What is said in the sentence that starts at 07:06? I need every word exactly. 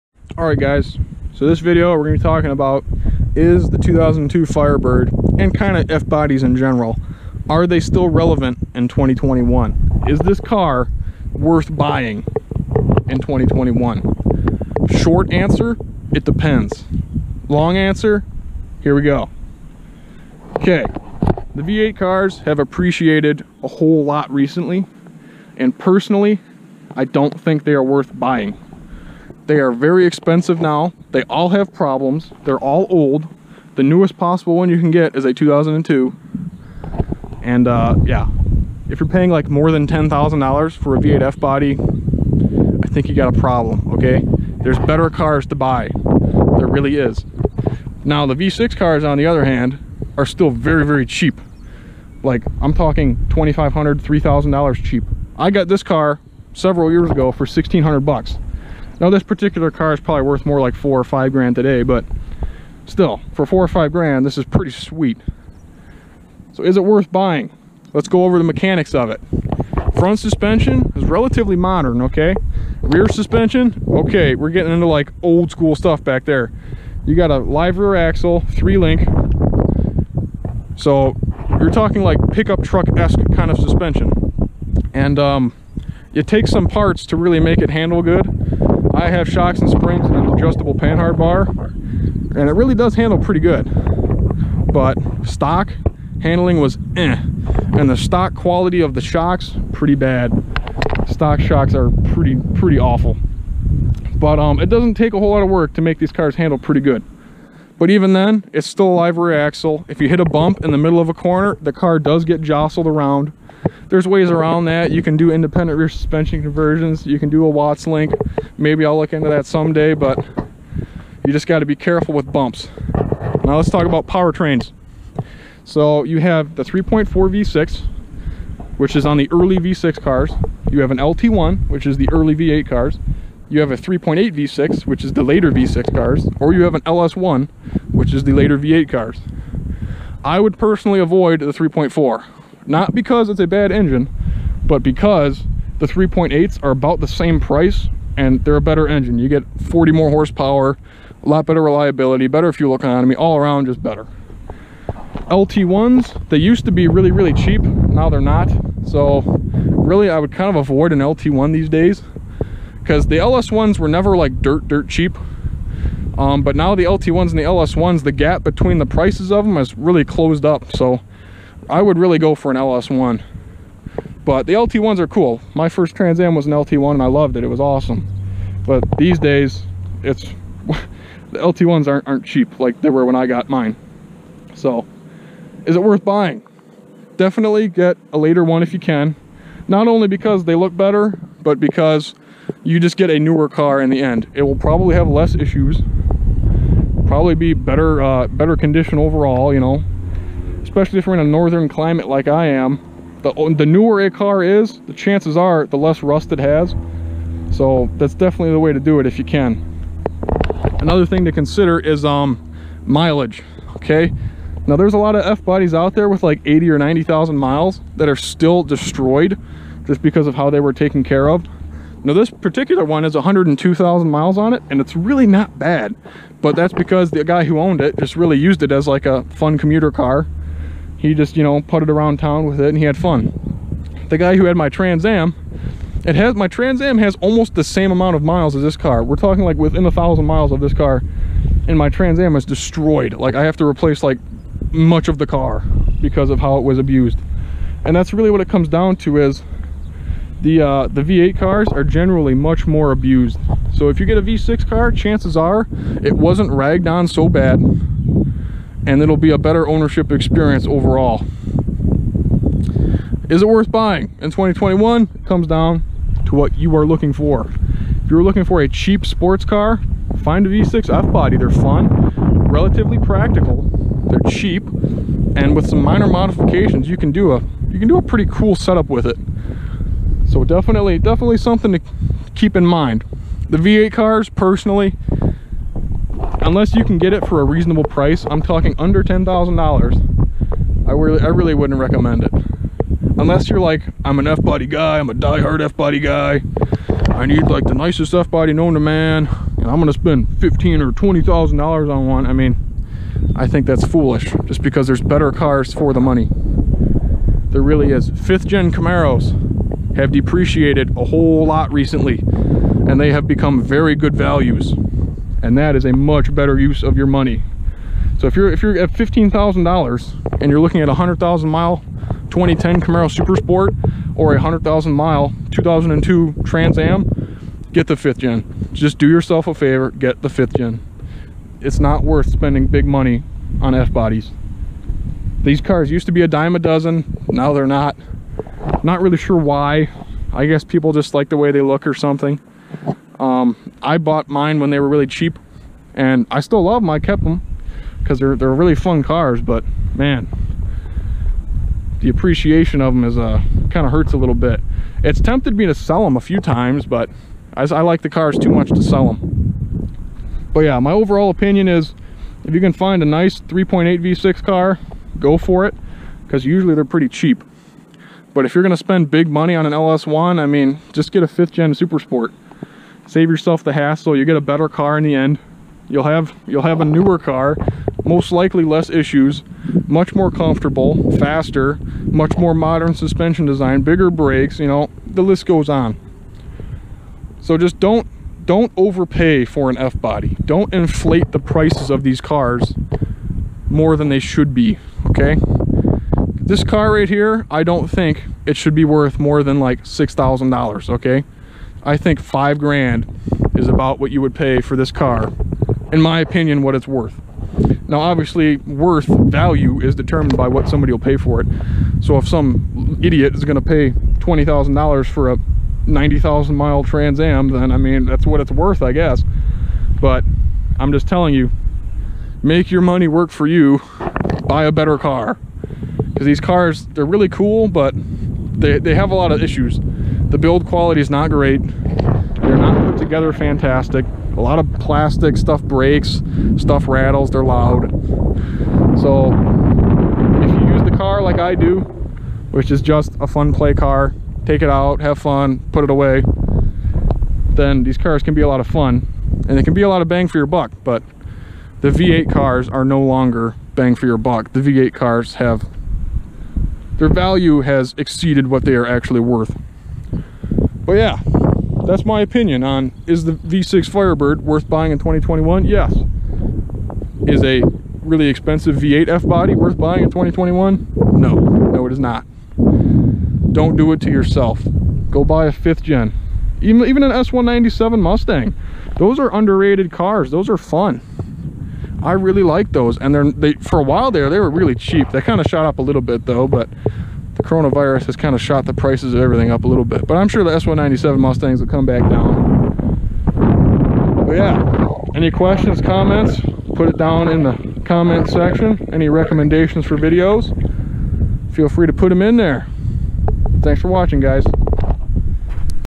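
Because these cars, they're really cool, but they, they have a lot of issues.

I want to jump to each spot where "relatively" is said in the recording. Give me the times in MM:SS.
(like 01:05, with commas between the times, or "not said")
01:11, 04:32.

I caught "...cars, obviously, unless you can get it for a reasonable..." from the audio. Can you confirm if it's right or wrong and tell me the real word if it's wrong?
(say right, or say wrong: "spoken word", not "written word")
wrong: "personally", not "obviously".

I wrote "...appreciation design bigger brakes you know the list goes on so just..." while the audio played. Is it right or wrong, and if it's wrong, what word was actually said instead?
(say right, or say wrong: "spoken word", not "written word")
wrong: "suspension", not "appreciation".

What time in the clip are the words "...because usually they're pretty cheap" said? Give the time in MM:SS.
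06:06.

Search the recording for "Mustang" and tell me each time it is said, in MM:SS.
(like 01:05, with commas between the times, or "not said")
07:57, 08:11.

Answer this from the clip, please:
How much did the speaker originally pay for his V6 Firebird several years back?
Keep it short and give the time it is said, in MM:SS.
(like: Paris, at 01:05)
$1,600, at 00:57.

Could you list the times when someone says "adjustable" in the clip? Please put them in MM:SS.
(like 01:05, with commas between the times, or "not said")
01:30.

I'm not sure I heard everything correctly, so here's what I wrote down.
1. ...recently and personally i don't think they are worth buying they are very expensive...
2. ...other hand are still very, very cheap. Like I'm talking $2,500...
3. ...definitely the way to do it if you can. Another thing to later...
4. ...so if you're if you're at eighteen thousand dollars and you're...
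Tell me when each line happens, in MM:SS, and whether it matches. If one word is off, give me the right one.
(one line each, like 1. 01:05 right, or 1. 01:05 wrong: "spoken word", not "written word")
1. 00:24 right
2. 00:49 right
3. 03:28 wrong: "consider", not "later"
4. 05:18 wrong: "fifteen", not "eighteen".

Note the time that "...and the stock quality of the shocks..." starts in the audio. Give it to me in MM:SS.
01:37.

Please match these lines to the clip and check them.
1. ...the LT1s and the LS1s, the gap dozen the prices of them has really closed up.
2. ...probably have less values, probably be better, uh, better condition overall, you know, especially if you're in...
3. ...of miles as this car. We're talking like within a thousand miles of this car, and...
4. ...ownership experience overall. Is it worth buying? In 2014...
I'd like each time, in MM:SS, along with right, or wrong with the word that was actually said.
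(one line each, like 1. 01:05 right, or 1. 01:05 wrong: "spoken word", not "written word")
1. 02:46 wrong: "between", not "dozen"
2. 03:14 wrong: "issues", not "values"
3. 03:58 right
4. 04:19 wrong: "2021", not "2014".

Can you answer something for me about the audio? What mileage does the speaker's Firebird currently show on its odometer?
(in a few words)
102,000 miles.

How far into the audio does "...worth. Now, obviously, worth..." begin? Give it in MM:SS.
06:46.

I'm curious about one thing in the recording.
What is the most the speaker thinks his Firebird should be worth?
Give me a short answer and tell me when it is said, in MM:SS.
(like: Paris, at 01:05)
$6,000, at 06:39.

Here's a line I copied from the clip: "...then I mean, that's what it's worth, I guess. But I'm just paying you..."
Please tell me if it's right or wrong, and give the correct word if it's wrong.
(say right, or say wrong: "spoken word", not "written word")
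wrong: "telling", not "paying".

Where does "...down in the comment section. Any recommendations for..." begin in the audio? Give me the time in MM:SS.
08:16.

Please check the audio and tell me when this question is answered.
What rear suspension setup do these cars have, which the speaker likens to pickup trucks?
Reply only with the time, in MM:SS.
01:17.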